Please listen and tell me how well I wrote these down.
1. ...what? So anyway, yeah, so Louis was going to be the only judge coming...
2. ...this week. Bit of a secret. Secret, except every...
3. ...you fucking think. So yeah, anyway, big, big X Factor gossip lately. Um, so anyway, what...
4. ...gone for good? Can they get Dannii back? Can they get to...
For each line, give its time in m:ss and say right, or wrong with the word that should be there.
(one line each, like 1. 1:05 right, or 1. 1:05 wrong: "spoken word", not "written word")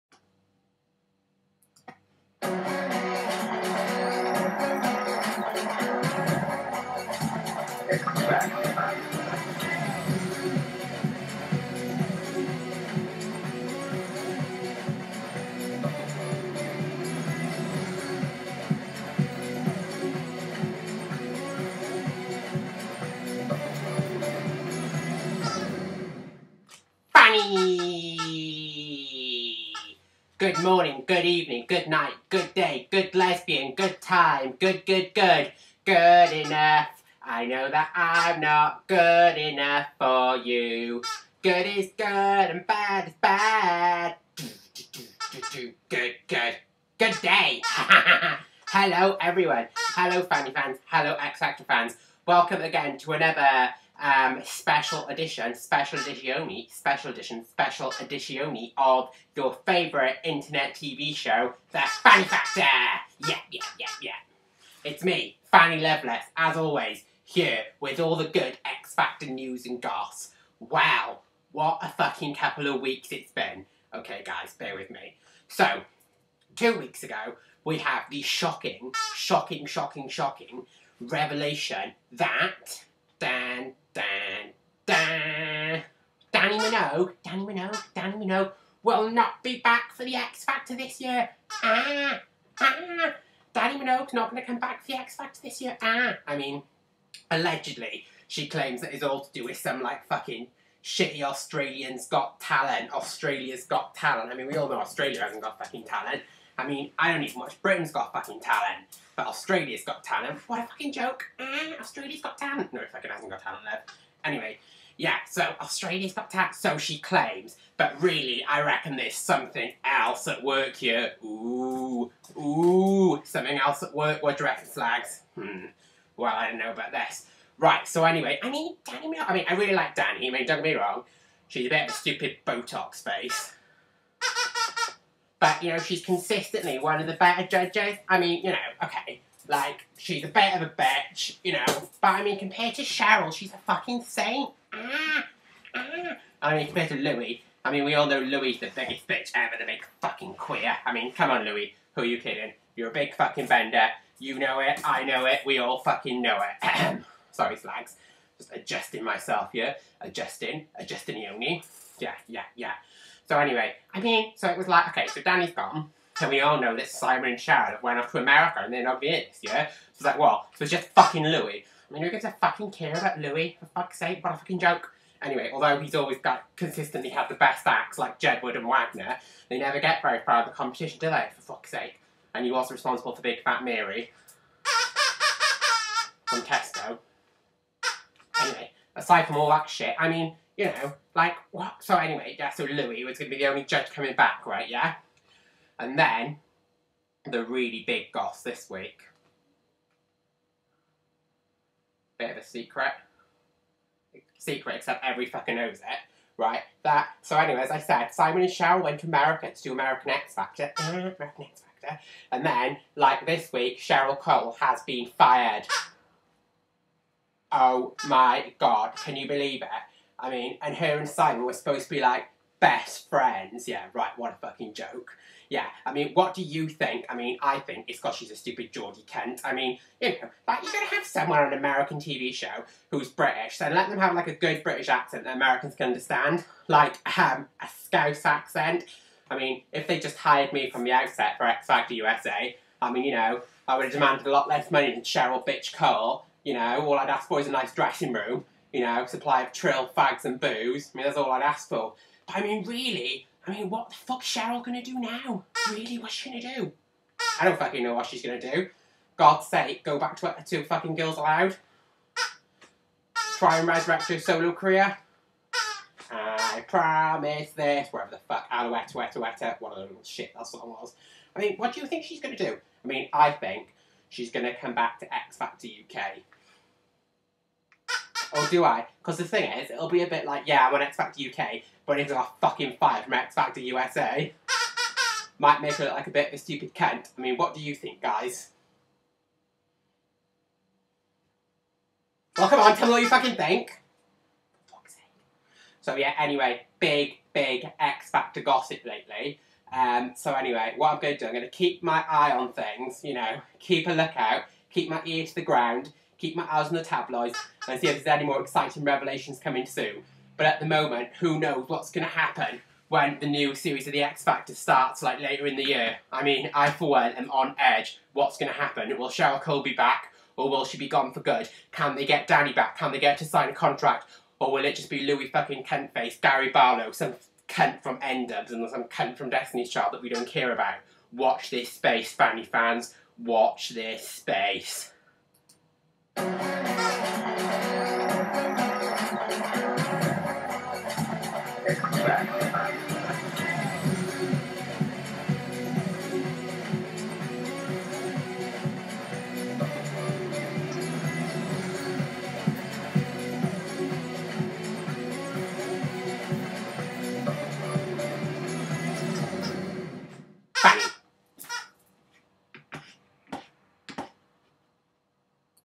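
1. 3:11 right
2. 3:18 right
3. 4:53 right
4. 5:20 right.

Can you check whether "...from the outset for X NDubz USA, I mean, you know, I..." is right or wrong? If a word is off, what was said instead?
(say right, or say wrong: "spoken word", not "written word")
wrong: "Factor", not "NDubz".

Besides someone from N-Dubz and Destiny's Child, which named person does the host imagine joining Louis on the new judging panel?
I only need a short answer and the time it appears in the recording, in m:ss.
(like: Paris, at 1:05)
Gary Barlow, at 5:26.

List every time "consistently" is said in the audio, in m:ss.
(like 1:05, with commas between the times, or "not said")
2:16, 2:56.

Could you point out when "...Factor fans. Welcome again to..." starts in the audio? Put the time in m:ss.
0:51.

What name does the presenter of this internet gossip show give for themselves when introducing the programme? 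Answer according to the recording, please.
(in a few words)
Fanny Loveless.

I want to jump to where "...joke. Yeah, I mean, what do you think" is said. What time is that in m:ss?
3:44.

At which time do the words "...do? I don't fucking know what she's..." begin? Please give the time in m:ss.
4:16.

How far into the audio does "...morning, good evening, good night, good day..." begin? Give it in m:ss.
0:30.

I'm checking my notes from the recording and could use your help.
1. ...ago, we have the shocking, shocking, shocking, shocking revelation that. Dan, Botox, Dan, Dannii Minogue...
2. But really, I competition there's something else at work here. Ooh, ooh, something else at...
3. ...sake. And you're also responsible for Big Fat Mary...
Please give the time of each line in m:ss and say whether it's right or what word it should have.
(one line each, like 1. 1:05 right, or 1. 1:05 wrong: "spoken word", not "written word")
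1. 1:17 wrong: "Dan", not "Botox"
2. 1:57 wrong: "reckon", not "competition"
3. 3:01 right.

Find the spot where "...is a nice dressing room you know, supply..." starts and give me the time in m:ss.
4:07.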